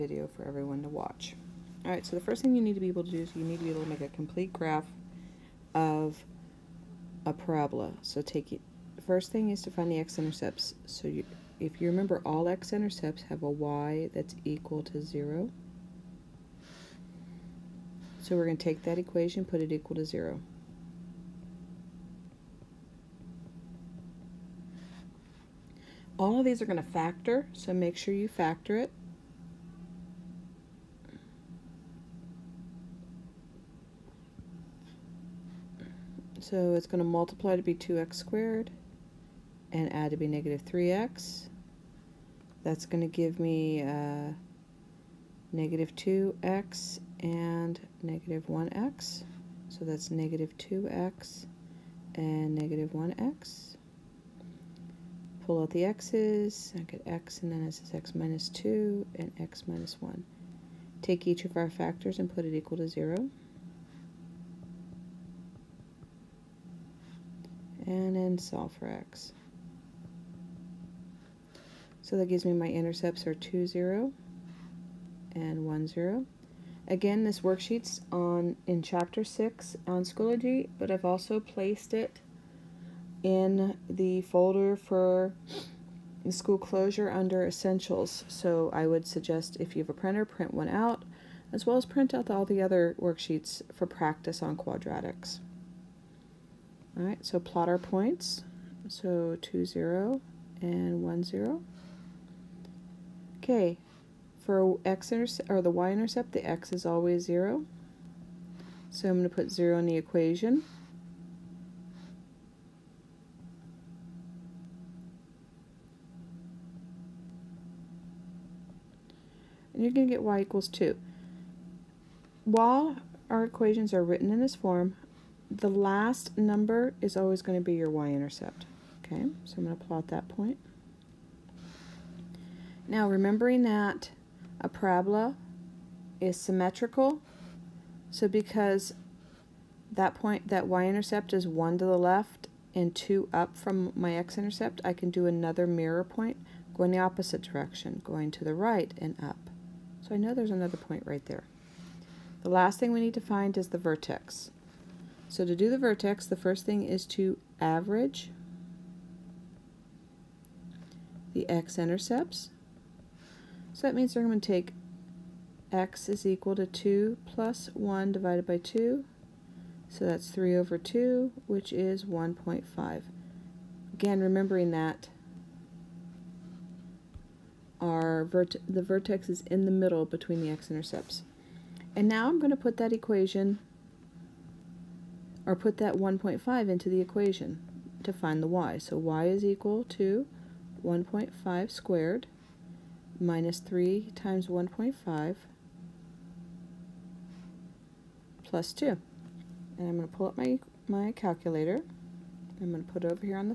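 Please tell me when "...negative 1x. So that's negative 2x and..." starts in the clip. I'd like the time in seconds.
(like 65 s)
48 s.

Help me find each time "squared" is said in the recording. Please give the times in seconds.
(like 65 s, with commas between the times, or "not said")
38 s, 191 s.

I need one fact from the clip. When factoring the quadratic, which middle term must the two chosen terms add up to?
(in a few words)
negative 3x.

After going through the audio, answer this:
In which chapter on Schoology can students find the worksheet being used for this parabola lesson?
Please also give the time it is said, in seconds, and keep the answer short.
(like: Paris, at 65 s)
Chapter 6, at 78 s.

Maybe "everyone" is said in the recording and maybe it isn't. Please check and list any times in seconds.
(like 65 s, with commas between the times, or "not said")
0 s.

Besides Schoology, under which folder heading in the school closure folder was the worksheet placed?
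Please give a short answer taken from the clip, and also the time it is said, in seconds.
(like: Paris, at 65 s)
Essentials, at 87 s.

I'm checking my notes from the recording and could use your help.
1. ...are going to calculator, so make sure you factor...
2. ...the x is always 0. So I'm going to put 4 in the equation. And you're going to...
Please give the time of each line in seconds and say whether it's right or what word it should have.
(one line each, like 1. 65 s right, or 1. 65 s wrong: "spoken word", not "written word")
1. 26 s wrong: "factor", not "calculator"
2. 106 s wrong: "0", not "4".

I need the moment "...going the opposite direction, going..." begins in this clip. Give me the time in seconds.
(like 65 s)
146 s.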